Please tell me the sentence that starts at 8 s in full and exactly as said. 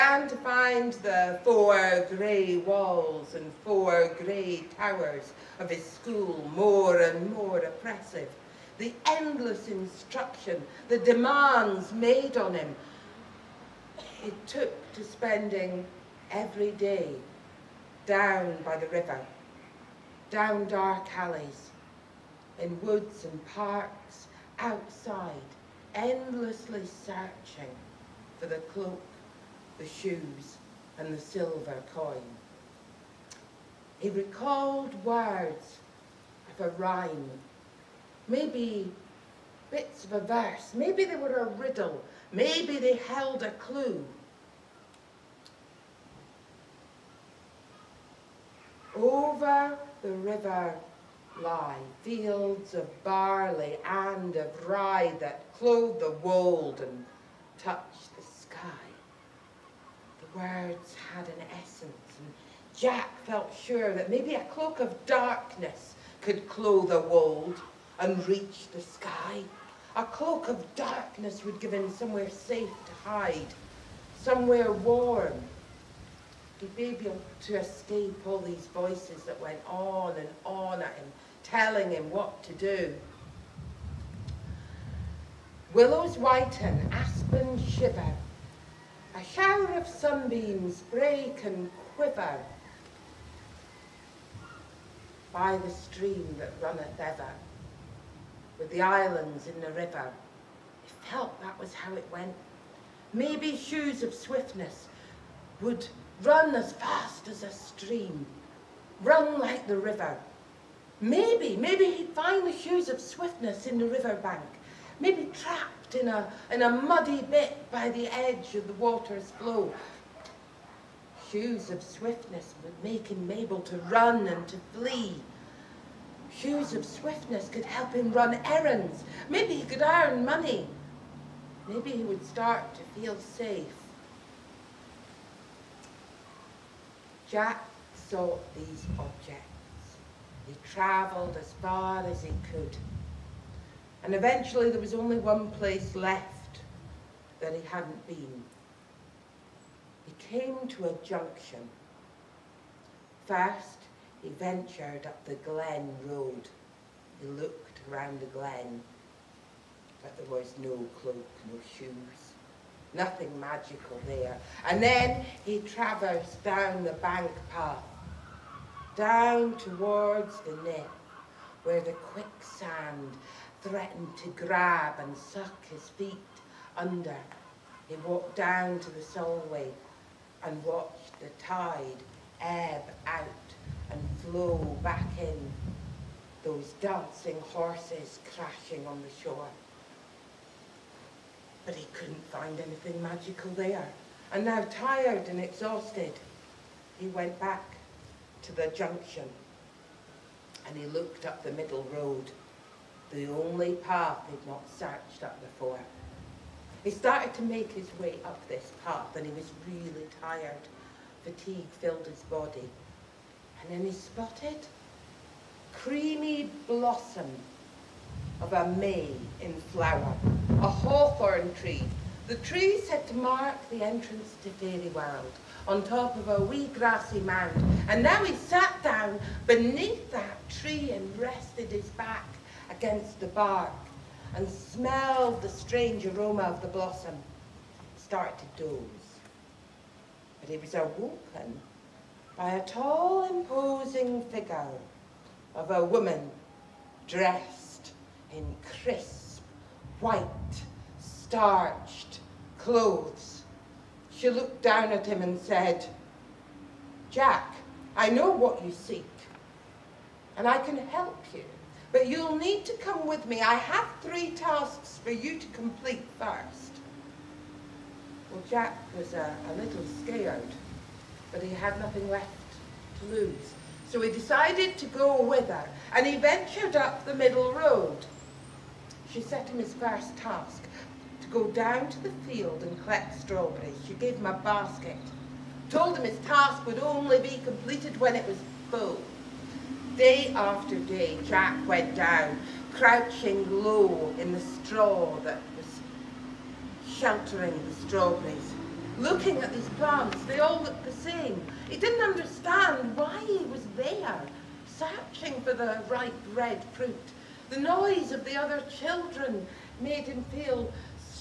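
The endless instruction, the demands made on him.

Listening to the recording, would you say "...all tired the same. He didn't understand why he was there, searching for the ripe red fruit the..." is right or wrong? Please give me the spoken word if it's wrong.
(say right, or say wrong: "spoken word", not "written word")
wrong: "looked", not "tired".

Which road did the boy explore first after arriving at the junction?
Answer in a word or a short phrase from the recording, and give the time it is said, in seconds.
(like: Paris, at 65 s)
Glen Road, at 155 s.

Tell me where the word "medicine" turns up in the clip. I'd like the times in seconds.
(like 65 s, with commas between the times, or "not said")
not said.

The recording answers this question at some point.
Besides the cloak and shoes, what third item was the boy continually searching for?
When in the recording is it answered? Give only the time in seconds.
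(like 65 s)
31 s.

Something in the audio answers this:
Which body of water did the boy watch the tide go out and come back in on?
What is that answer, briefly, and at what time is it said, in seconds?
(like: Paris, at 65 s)
the Solway, at 178 s.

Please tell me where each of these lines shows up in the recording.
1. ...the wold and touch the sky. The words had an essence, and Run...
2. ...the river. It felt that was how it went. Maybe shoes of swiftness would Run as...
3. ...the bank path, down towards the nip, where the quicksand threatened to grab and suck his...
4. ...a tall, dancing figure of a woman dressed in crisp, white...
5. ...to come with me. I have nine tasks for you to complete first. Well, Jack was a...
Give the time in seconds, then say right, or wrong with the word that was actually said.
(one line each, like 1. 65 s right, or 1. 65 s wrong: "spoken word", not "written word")
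1. 56 s wrong: "Jack", not "Run"
2. 99 s right
3. 166 s right
4. 242 s wrong: "imposing", not "dancing"
5. 262 s wrong: "three", not "nine".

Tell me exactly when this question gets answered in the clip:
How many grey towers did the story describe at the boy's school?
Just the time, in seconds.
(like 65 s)
3 s.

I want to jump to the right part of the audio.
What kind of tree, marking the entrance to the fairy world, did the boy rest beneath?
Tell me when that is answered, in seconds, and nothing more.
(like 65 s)
220 s.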